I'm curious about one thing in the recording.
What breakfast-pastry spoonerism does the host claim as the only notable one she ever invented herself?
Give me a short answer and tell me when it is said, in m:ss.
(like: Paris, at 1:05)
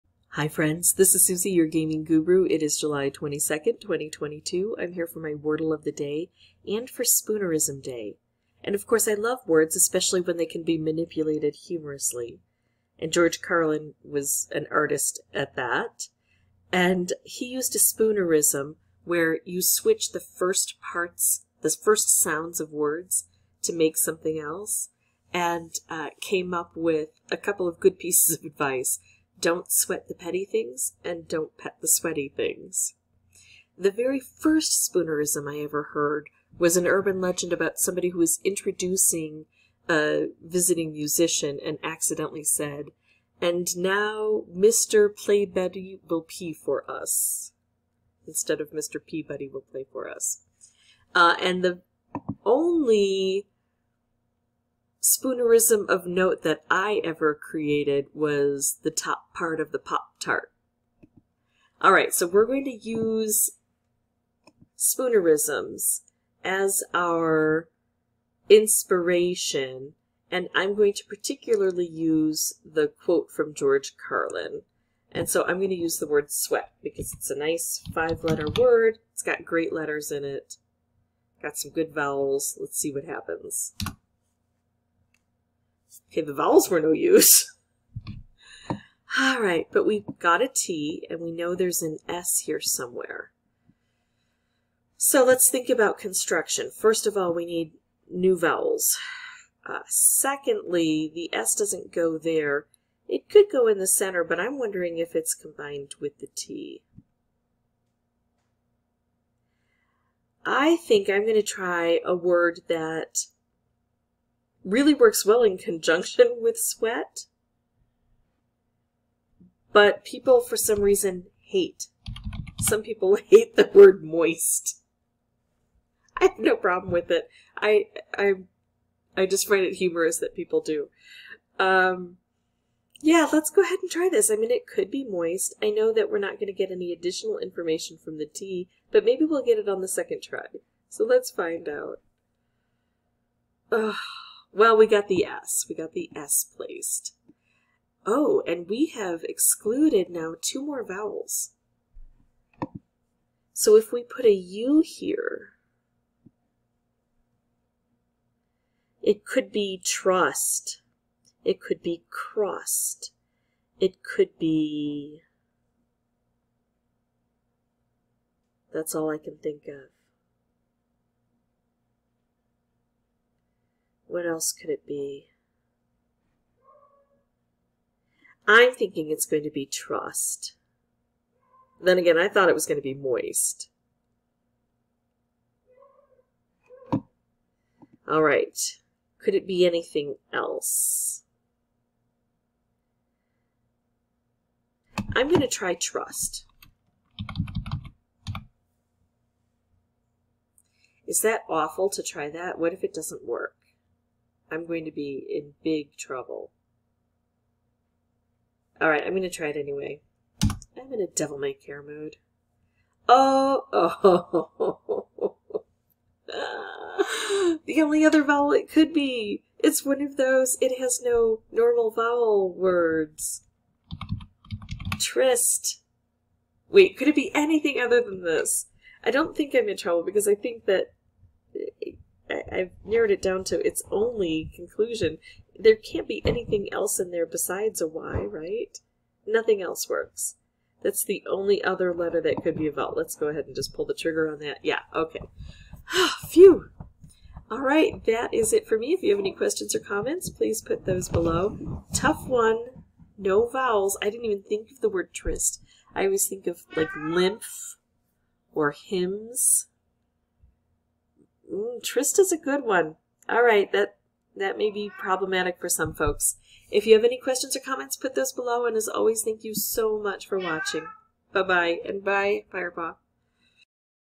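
the top part of the Pop Tart, at 0:58.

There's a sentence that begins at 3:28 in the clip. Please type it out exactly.
Alright, I'm going to try it anyway.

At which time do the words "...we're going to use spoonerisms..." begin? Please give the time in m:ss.
1:02.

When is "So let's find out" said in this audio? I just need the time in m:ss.
2:20.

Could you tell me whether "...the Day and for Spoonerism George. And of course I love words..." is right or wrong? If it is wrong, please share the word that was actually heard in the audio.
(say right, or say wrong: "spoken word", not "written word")
wrong: "Day", not "George".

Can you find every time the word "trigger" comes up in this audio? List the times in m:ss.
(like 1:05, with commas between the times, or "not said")
4:03.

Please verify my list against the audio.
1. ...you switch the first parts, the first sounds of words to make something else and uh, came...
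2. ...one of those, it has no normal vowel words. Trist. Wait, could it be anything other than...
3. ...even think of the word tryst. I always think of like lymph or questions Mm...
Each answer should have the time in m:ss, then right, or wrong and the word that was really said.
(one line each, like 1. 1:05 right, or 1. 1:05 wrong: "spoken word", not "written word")
1. 0:19 right
2. 3:39 right
3. 4:14 wrong: "hymns", not "questions".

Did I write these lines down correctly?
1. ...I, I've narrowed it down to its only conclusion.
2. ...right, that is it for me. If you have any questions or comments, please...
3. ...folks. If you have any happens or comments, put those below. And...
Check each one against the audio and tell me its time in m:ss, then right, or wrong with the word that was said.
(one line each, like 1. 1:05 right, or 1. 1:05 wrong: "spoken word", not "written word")
1. 3:52 right
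2. 4:07 right
3. 4:25 wrong: "questions", not "happens".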